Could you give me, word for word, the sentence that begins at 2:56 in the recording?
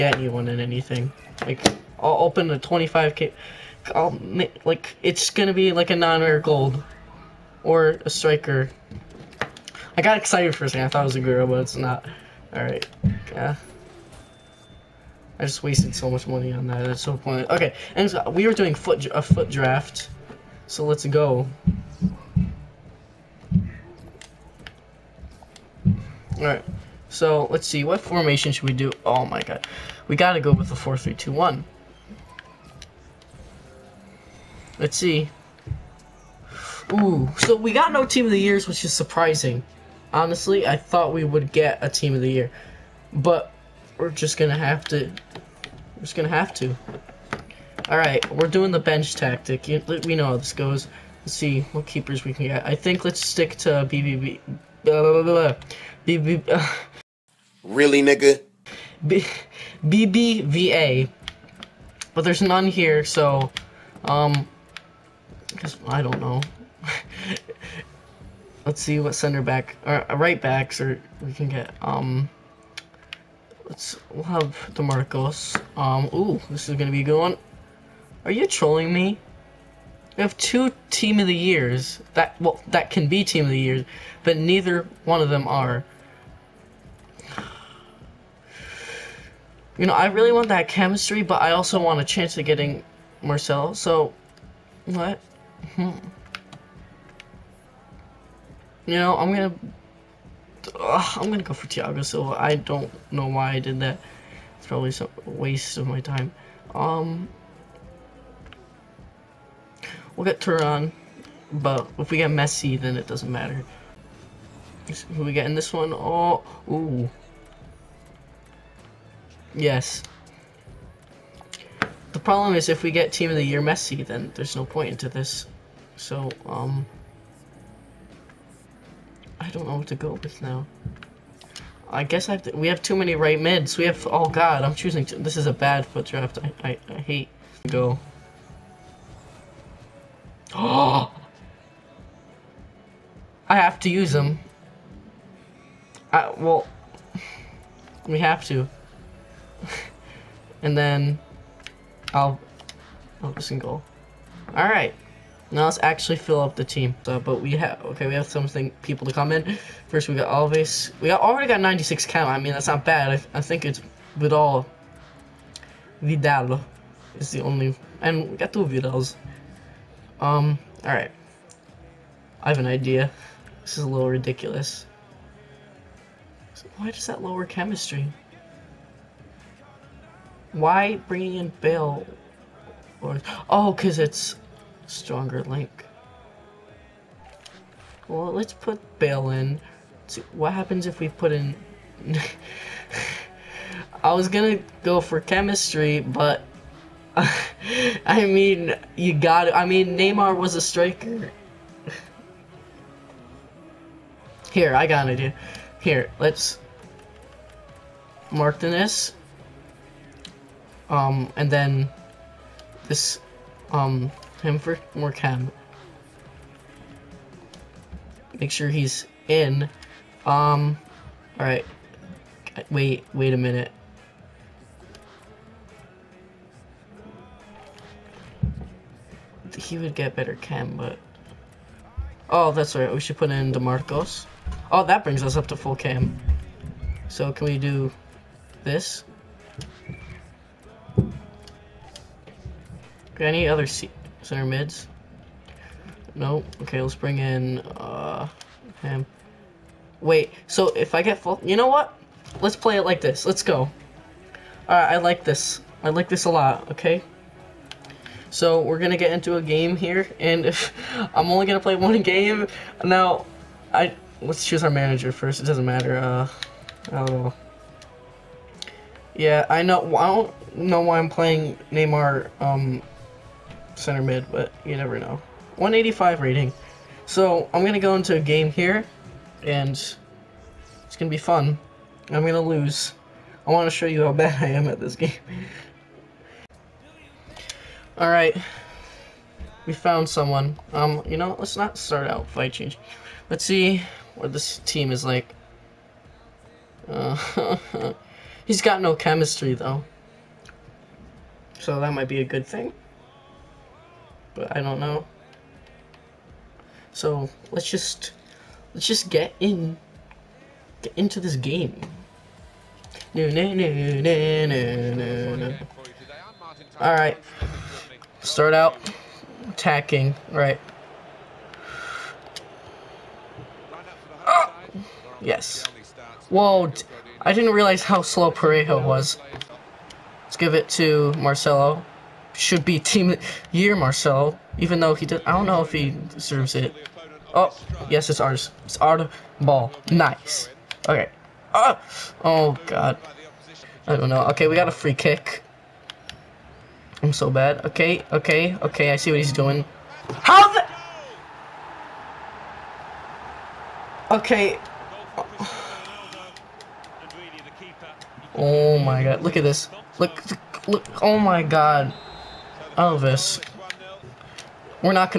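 So why does that lower chemistry?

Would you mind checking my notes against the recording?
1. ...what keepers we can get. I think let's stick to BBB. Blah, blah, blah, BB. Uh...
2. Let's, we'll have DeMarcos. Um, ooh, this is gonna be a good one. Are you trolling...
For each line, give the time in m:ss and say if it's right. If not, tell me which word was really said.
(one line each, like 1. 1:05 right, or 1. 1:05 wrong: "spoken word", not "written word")
1. 0:51 right
2. 1:13 right.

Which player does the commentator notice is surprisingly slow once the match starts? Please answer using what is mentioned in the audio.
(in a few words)
Parejo.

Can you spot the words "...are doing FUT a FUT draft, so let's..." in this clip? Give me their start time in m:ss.
0:18.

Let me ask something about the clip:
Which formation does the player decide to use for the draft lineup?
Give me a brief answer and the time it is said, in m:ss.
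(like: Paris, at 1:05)
4-3-2-1, at 0:30.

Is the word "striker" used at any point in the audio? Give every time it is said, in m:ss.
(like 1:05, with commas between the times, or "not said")
0:08, 3:20.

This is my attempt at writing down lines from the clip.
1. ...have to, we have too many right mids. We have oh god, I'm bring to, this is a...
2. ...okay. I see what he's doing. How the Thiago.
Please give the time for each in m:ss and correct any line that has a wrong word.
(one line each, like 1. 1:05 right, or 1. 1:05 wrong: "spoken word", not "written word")
1. 2:12 wrong: "choosing", not "bring"
2. 5:48 wrong: "Okay", not "Thiago".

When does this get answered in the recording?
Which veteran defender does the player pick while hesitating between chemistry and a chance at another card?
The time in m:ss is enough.
1:41.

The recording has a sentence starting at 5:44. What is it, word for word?
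Okay, we got a free kick.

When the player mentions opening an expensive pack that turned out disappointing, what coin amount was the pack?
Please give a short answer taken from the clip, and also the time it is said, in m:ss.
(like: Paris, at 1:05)
25k, at 0:02.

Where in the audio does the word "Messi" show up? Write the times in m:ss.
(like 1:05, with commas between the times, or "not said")
1:52, 2:03.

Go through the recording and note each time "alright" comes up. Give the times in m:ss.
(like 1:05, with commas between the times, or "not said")
0:47, 3:41, 4:14, 4:47.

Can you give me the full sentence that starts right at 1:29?
You know, I really want that chemistry, but I also want a chance of getting Marcel, so...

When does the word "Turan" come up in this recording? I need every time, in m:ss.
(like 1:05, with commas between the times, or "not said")
1:50.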